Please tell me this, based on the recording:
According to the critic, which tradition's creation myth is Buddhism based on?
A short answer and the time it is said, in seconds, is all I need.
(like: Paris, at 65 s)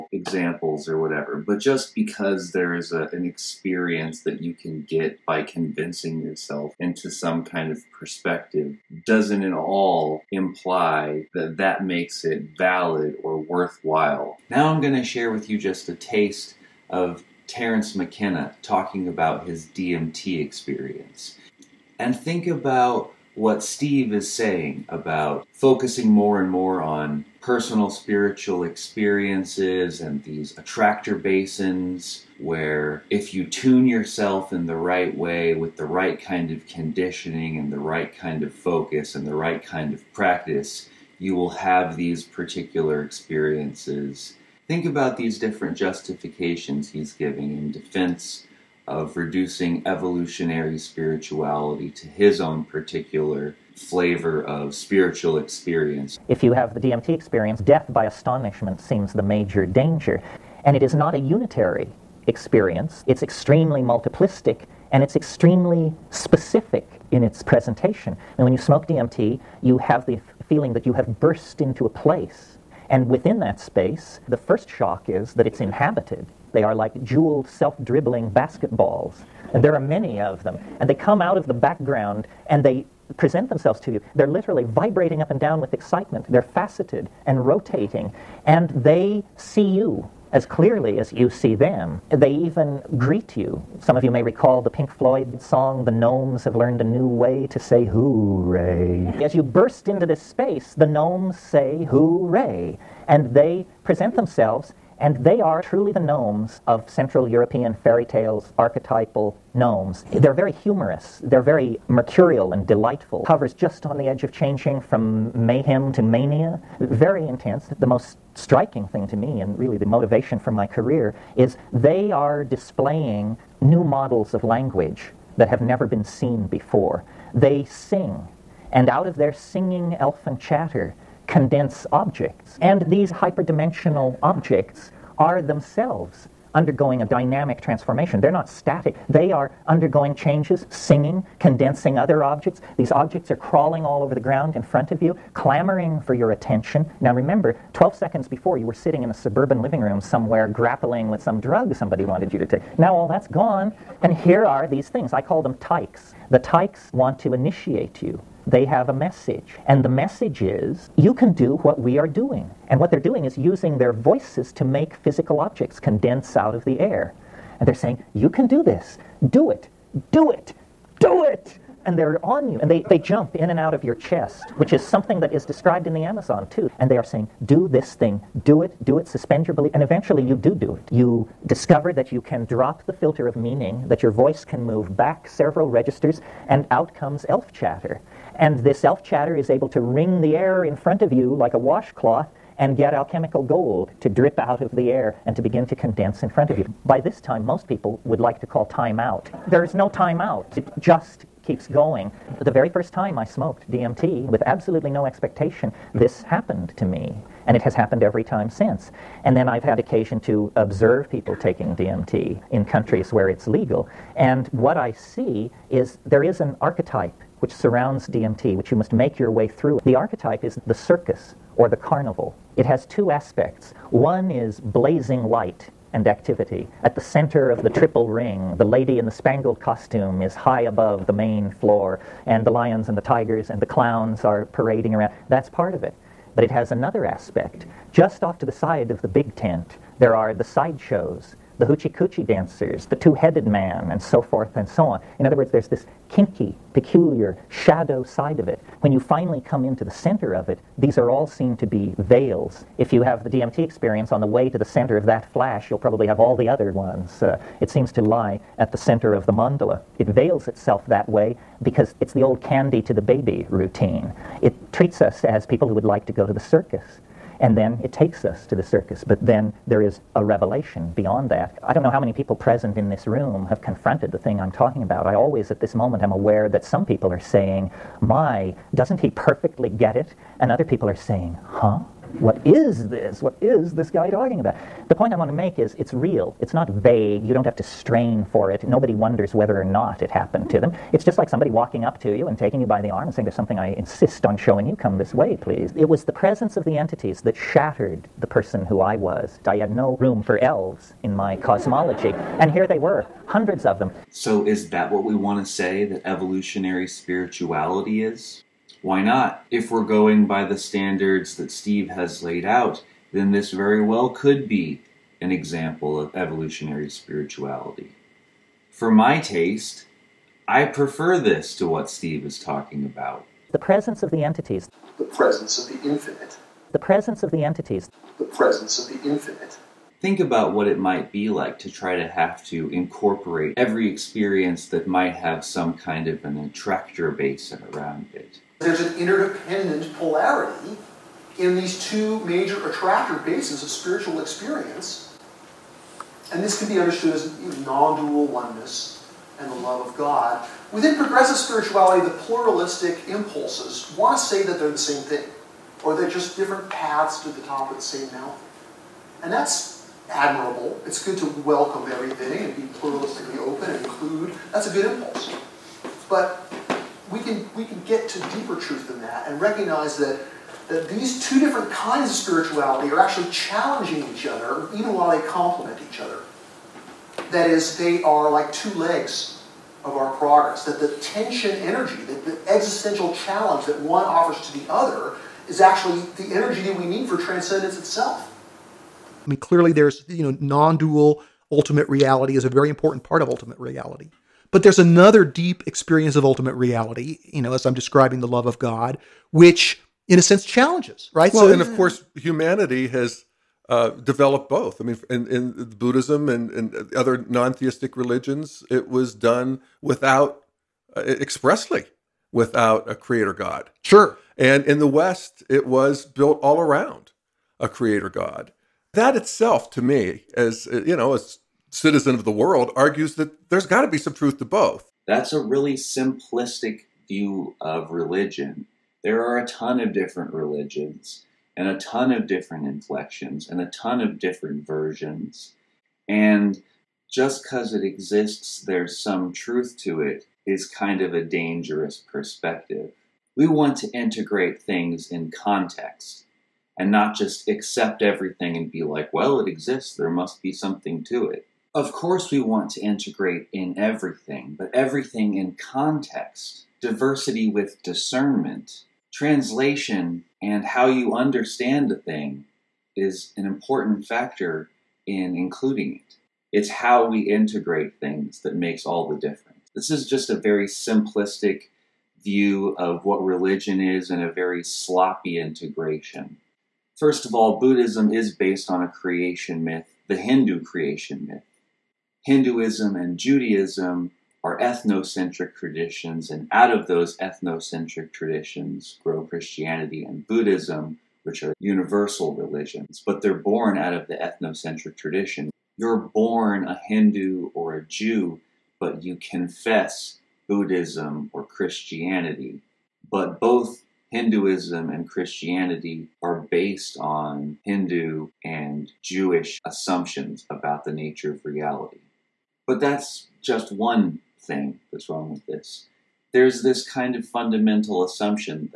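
Hindu creation myth, at 480 s.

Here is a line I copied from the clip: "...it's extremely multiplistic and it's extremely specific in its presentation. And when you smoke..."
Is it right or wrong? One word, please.
right.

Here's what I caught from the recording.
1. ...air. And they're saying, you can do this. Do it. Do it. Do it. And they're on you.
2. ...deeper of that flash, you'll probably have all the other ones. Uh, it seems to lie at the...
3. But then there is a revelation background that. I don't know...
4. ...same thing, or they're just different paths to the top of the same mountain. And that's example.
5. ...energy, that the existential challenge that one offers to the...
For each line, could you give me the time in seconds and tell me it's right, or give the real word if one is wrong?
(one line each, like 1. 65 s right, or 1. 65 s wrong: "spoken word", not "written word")
1. 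166 s right
2. 254 s wrong: "center", not "deeper"
3. 269 s wrong: "beyond", not "background"
4. 354 s wrong: "admirable", not "example"
5. 381 s right.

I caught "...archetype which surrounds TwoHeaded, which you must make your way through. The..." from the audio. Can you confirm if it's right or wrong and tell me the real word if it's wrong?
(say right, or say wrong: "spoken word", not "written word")
wrong: "DMT", not "TwoHeaded".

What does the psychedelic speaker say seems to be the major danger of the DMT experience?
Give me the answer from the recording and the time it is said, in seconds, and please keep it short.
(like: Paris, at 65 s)
Death by astonishment, at 57 s.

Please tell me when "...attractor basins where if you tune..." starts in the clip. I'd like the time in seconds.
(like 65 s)
30 s.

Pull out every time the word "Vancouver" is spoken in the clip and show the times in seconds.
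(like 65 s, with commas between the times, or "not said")
not said.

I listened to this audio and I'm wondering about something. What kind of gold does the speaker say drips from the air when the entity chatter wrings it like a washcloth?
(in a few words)
Alchemical gold.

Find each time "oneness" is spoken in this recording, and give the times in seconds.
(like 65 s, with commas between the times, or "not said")
348 s.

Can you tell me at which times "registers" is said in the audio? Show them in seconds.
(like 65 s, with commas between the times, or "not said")
185 s.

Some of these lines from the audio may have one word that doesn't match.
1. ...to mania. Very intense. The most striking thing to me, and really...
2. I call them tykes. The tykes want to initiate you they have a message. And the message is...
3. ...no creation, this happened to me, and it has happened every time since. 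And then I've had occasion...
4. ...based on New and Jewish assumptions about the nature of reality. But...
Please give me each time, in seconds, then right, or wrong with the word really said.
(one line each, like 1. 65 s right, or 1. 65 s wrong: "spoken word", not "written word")
1. 115 s right
2. 155 s right
3. 204 s wrong: "expectation", not "creation"
4. 506 s wrong: "Hindu", not "New".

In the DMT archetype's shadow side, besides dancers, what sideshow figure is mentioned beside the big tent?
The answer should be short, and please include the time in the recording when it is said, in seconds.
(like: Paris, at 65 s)
The Two-Headed Man, at 242 s.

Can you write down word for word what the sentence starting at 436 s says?
And just because it exists, there's some truth to it, is kind of a dangerous perspective.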